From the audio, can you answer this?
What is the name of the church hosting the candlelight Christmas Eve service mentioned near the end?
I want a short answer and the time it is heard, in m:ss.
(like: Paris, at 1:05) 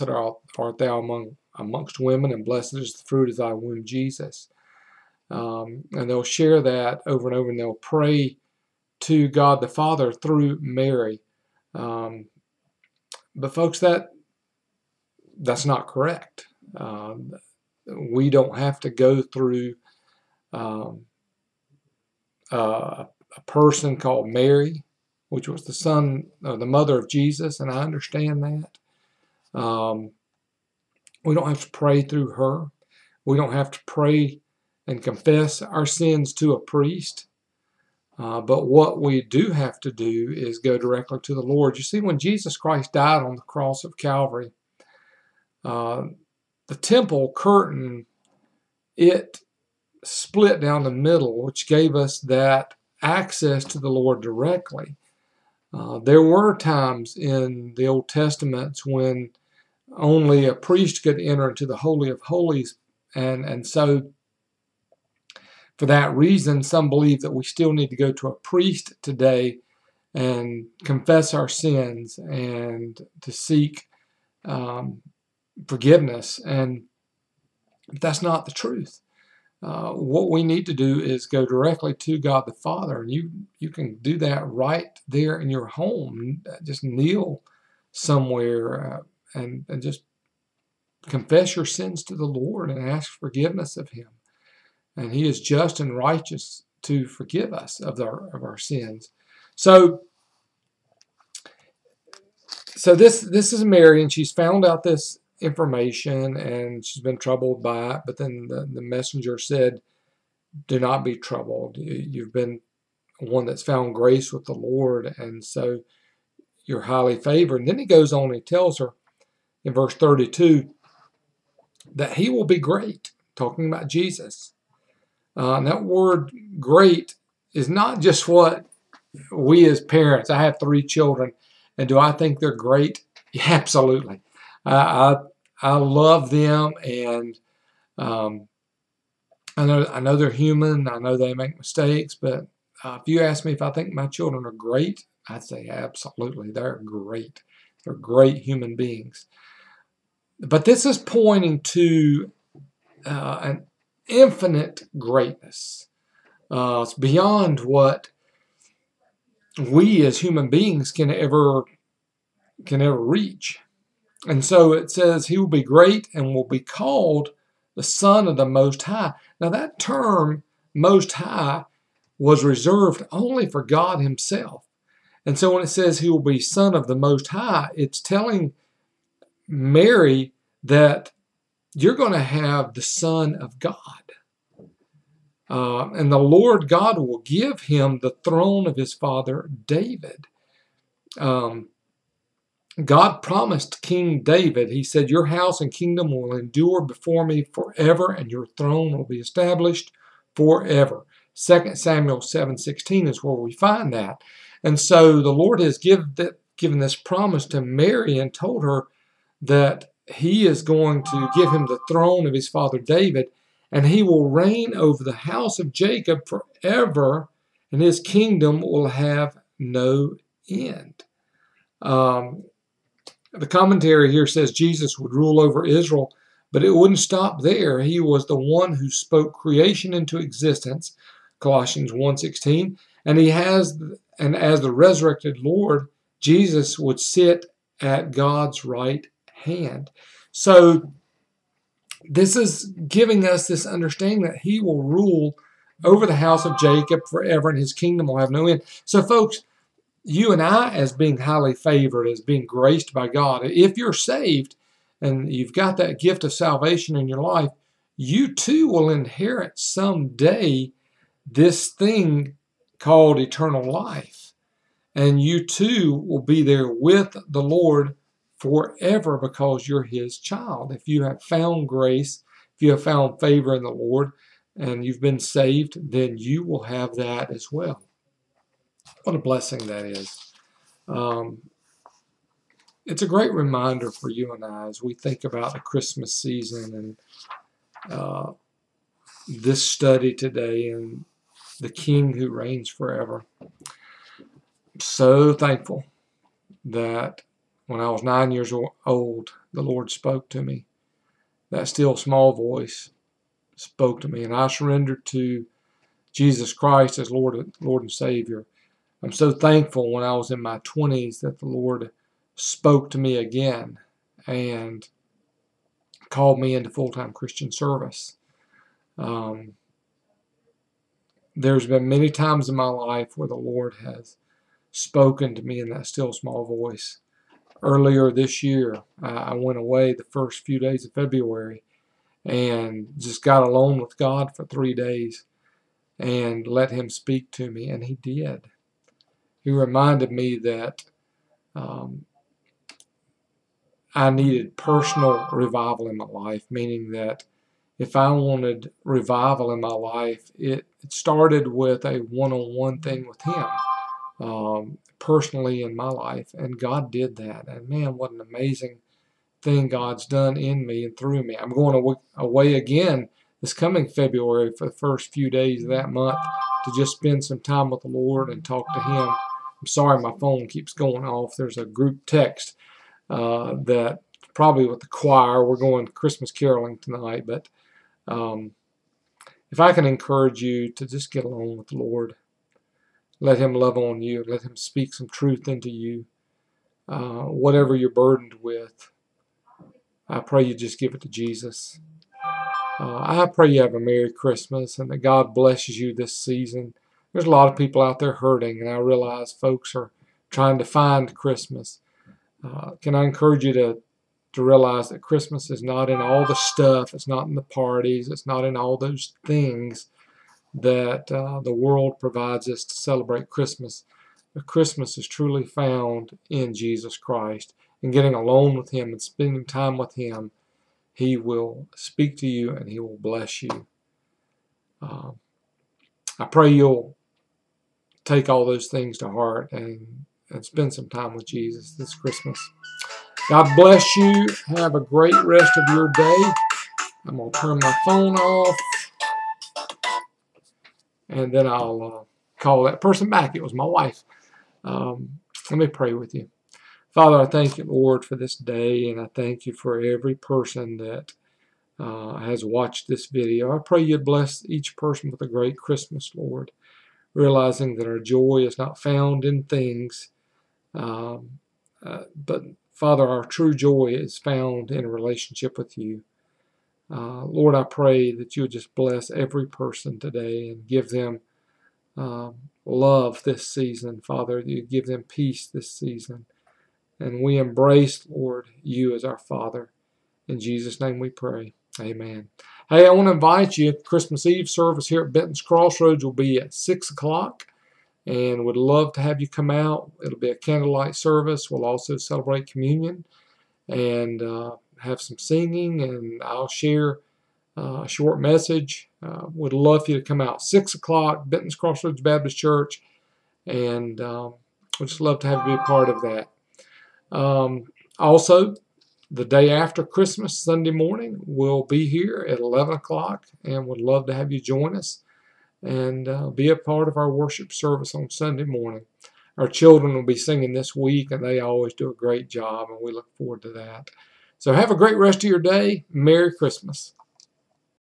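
Benton's Crossroads Baptist Church, at 8:21.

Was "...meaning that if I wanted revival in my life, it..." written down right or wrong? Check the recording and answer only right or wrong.
right.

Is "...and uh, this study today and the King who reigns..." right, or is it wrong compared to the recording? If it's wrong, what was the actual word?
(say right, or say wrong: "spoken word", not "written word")
right.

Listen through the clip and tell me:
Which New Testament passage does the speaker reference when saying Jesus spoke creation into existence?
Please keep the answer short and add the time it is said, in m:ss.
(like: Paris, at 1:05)
Colossians 1:16, at 3:51.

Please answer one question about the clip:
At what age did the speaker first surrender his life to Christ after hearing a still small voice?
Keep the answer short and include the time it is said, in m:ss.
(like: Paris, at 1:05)
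9, at 4:58.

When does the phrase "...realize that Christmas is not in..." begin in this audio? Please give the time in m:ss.
6:44.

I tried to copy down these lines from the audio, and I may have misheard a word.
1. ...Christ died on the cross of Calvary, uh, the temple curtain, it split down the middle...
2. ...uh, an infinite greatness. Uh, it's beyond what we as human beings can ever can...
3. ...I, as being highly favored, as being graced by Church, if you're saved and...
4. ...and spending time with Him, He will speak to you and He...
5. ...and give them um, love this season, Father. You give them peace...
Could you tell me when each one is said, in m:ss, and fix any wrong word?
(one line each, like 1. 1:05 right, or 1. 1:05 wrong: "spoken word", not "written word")
1. 0:42 right
2. 2:33 right
3. 4:10 wrong: "God", not "Church"
4. 6:58 right
5. 7:50 right.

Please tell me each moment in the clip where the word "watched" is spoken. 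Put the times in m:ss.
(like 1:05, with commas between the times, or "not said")
7:32.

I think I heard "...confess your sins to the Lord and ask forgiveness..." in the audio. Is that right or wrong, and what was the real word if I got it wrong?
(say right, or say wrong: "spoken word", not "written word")
right.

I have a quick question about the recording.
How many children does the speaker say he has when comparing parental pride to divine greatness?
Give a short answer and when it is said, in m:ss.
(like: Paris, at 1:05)
3, at 2:10.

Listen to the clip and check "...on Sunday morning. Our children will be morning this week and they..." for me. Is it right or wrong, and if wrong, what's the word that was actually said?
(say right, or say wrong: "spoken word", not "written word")
wrong: "singing", not "morning".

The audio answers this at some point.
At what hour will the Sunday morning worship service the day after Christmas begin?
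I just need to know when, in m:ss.
8:32.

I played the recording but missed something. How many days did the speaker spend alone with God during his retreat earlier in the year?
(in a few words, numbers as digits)
3.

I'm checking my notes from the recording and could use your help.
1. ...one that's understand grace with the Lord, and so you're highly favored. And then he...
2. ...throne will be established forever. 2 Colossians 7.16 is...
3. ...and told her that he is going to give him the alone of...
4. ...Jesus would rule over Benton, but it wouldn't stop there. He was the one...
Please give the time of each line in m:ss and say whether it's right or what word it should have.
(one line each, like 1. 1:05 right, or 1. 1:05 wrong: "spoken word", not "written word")
1. 1:53 wrong: "found", not "understand"
2. 3:18 wrong: "Samuel", not "Colossians"
3. 3:28 wrong: "throne", not "alone"
4. 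3:44 wrong: "Israel", not "Benton".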